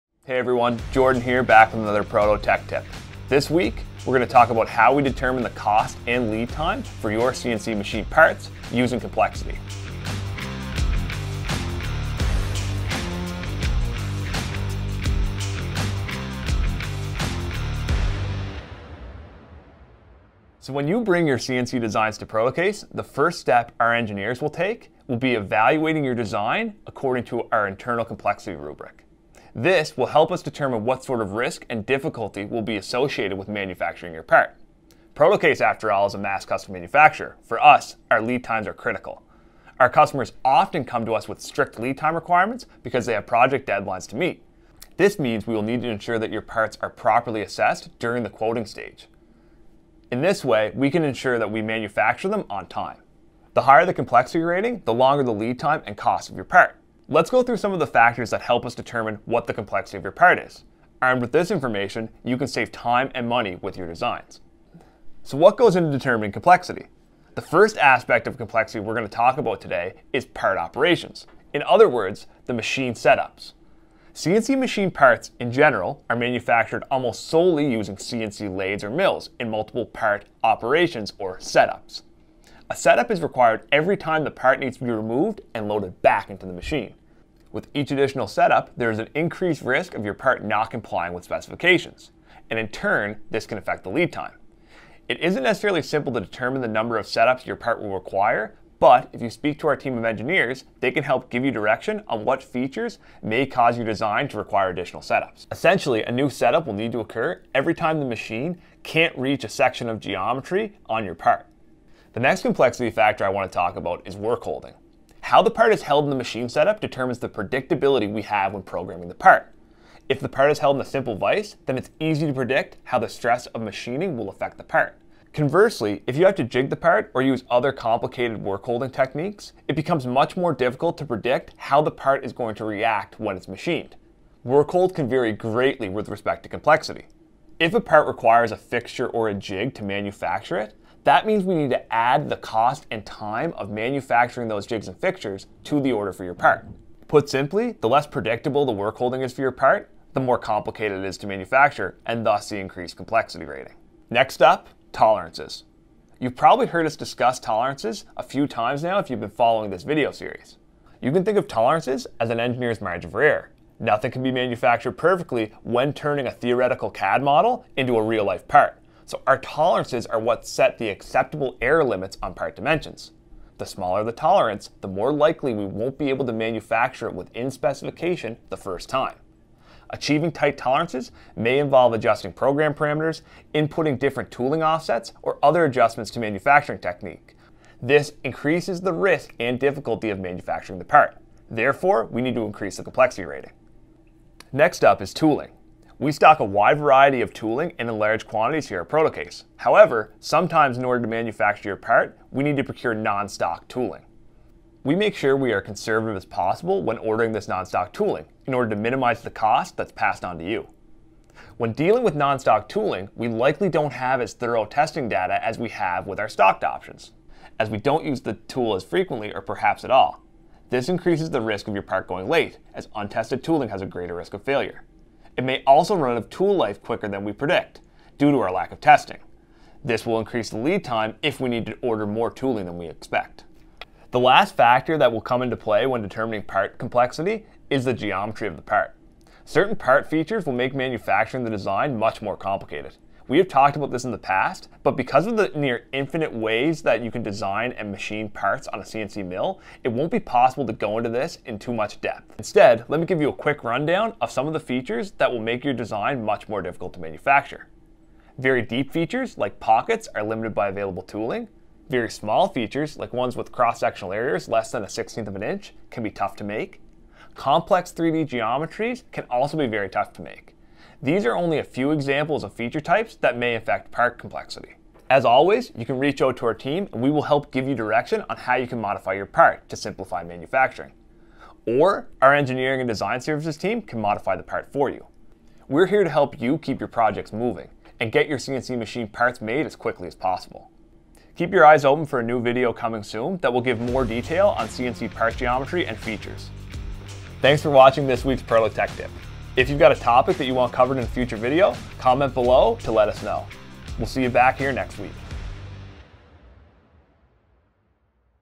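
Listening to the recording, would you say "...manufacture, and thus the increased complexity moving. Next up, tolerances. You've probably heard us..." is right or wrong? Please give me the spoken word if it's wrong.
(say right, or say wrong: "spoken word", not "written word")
wrong: "rating", not "moving".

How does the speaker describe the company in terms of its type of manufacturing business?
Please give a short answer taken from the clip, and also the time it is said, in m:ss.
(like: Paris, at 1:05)
mass custom manufacturer, at 0:36.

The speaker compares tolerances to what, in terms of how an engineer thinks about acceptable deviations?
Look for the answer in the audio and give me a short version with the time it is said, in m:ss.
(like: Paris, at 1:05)
margin for error, at 2:42.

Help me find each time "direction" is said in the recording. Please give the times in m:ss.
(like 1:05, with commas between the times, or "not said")
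1:41, 4:37.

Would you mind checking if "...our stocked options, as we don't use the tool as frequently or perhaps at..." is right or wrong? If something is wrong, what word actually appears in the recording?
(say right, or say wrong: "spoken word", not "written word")
right.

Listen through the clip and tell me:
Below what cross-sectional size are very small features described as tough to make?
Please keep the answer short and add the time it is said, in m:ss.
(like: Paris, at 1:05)
1/16 of an inch, at 4:24.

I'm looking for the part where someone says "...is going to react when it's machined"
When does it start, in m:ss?
2:12.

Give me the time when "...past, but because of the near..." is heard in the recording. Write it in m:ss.
4:04.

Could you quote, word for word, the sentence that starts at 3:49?
This will increase the lead time if we need to order more tooling than we expect.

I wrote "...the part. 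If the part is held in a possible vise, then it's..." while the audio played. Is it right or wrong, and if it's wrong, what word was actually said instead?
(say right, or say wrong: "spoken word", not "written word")
wrong: "simple", not "possible".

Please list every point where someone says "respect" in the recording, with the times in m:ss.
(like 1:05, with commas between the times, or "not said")
2:16.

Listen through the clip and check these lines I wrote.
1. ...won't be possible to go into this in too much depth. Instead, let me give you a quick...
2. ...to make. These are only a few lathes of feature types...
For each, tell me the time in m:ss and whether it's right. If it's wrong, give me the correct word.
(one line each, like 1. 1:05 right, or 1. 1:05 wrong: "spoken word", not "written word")
1. 4:09 right
2. 4:30 wrong: "examples", not "lathes".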